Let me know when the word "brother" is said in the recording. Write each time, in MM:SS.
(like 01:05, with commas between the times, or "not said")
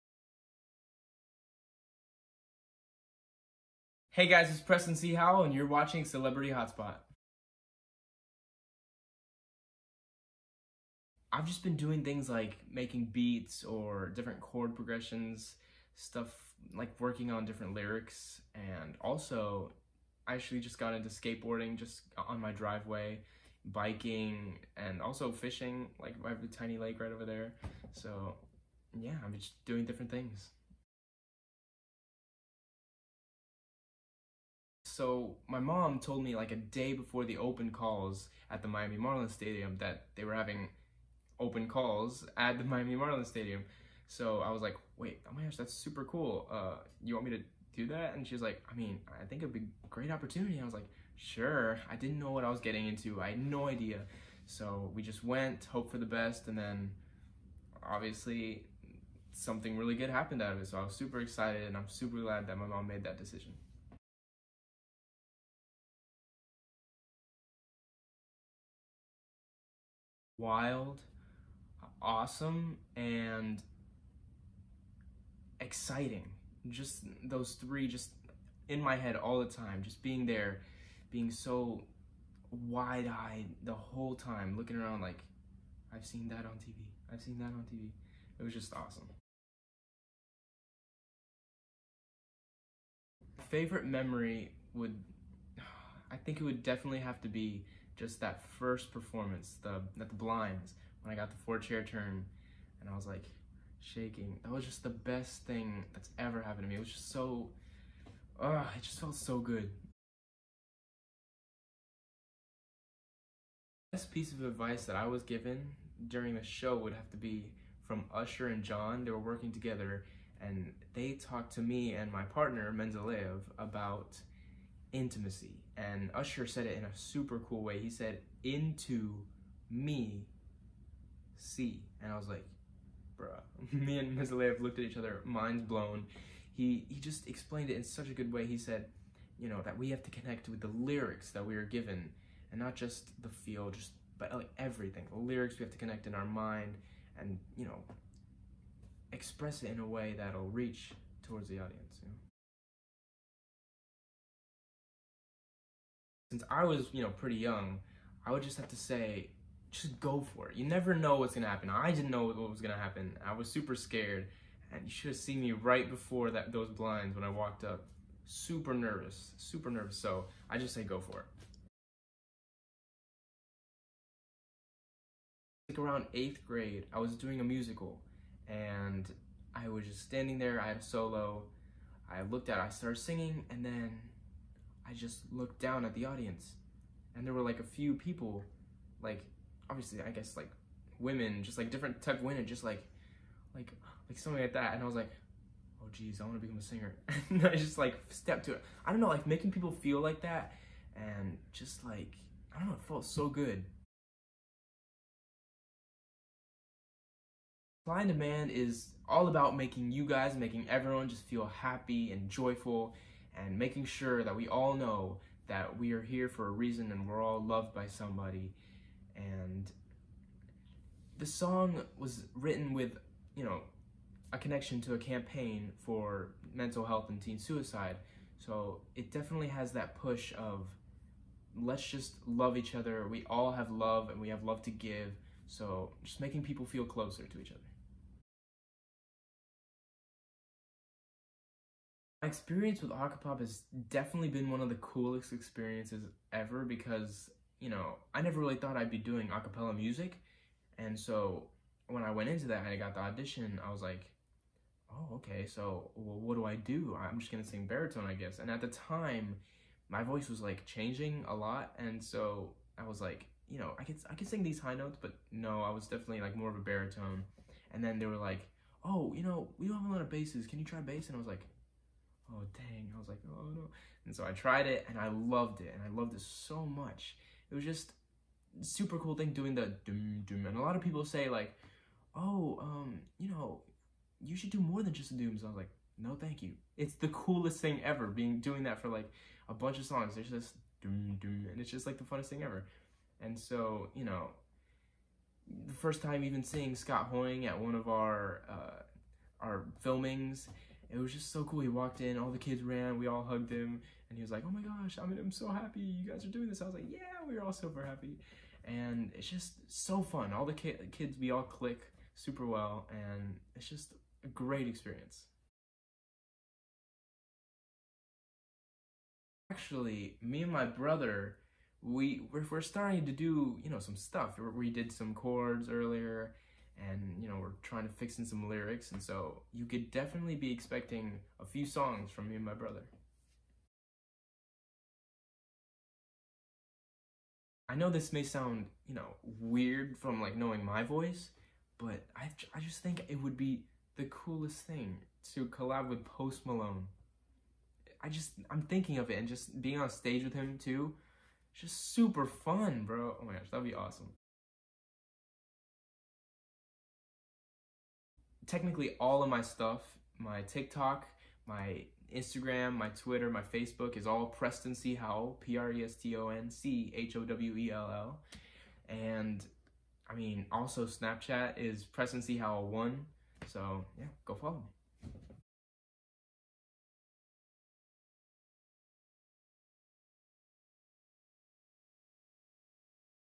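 05:20, 05:32.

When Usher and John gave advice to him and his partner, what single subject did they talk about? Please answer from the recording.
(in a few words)
Intimacy.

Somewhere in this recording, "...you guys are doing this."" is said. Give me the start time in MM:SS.
05:05.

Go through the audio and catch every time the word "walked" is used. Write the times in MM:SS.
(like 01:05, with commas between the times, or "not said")
02:47, 05:01.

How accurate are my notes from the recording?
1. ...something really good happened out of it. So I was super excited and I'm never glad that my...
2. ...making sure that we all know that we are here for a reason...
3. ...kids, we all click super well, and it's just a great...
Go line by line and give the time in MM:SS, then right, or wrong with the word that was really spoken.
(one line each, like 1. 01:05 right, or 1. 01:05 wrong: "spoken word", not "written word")
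1. 00:59 wrong: "super", not "never"
2. 03:33 right
3. 05:10 right.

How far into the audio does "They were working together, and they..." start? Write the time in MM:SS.
01:59.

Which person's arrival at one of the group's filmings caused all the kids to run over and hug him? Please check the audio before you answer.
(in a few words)
Scott Hoying.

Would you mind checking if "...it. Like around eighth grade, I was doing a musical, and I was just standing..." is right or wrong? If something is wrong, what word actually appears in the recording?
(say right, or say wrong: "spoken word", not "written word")
right.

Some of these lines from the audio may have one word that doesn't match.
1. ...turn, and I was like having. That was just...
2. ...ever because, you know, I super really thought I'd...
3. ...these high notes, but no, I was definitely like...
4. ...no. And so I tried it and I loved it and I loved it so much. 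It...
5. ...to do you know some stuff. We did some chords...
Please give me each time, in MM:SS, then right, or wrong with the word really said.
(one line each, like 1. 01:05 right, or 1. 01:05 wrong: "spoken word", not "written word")
1. 01:41 wrong: "shaking", not "having"
2. 04:06 wrong: "never", not "super"
3. 04:24 right
4. 04:33 right
5. 05:23 right.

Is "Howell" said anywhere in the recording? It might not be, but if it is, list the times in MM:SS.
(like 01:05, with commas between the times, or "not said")
00:05, 06:04, 06:12.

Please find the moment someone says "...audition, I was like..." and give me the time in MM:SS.
04:13.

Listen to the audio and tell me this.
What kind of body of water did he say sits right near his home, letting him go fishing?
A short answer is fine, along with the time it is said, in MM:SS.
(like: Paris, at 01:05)
A tiny lake, at 00:26.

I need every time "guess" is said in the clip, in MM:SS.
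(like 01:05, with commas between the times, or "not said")
03:10, 04:18.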